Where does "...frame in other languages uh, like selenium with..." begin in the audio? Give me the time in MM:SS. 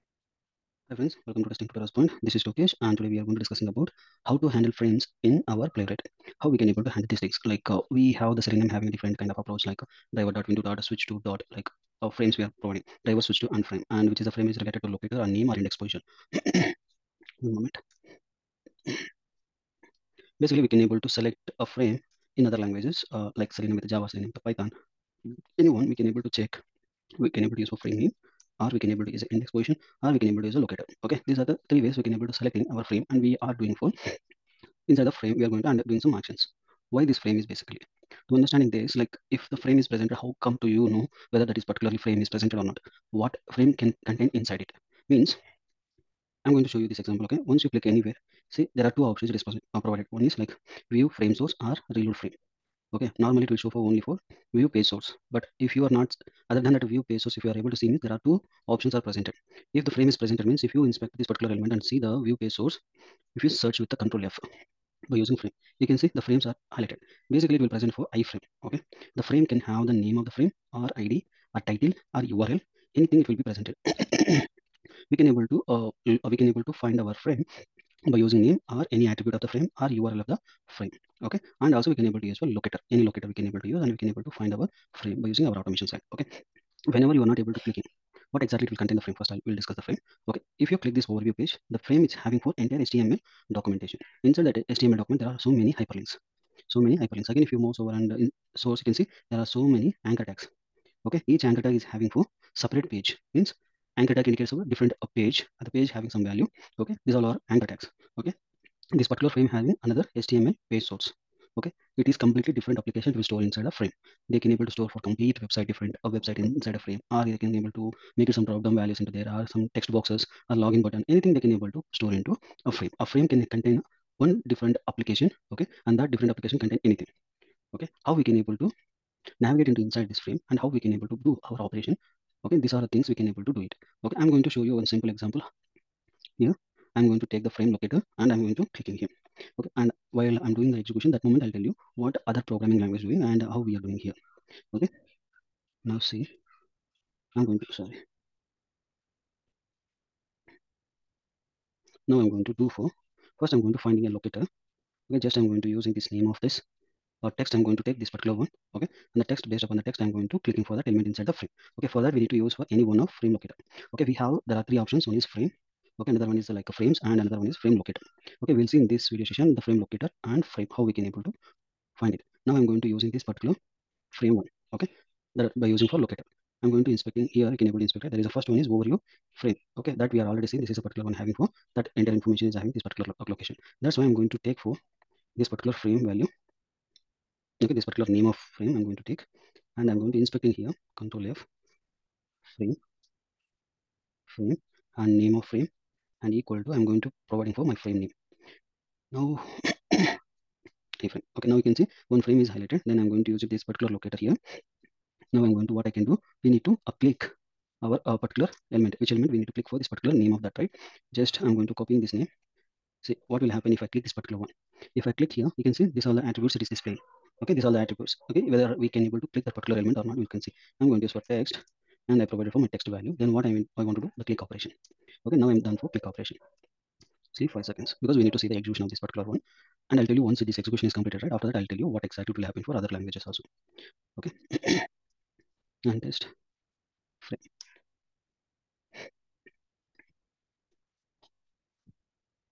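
00:21.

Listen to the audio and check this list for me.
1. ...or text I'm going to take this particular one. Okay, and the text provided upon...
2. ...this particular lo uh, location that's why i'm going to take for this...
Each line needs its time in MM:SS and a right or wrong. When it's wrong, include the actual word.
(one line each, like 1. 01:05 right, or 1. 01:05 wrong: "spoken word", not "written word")
1. 02:37 wrong: "based", not "provided"
2. 03:02 right.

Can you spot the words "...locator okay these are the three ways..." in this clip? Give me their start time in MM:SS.
00:30.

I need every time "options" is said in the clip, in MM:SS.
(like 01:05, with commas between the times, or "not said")
00:49, 00:58, 02:44.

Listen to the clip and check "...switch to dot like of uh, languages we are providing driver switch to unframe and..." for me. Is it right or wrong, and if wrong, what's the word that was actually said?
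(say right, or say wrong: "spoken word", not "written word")
wrong: "frames", not "languages".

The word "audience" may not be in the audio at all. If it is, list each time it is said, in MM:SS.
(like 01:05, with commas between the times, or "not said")
not said.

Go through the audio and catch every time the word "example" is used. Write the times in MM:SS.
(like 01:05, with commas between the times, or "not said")
00:46, 02:15.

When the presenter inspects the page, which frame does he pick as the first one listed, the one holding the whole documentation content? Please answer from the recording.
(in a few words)
Overview frame.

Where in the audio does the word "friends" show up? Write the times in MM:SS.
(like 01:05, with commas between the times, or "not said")
00:00.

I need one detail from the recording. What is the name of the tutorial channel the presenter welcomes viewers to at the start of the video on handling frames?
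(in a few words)
Testing Tutorials Point.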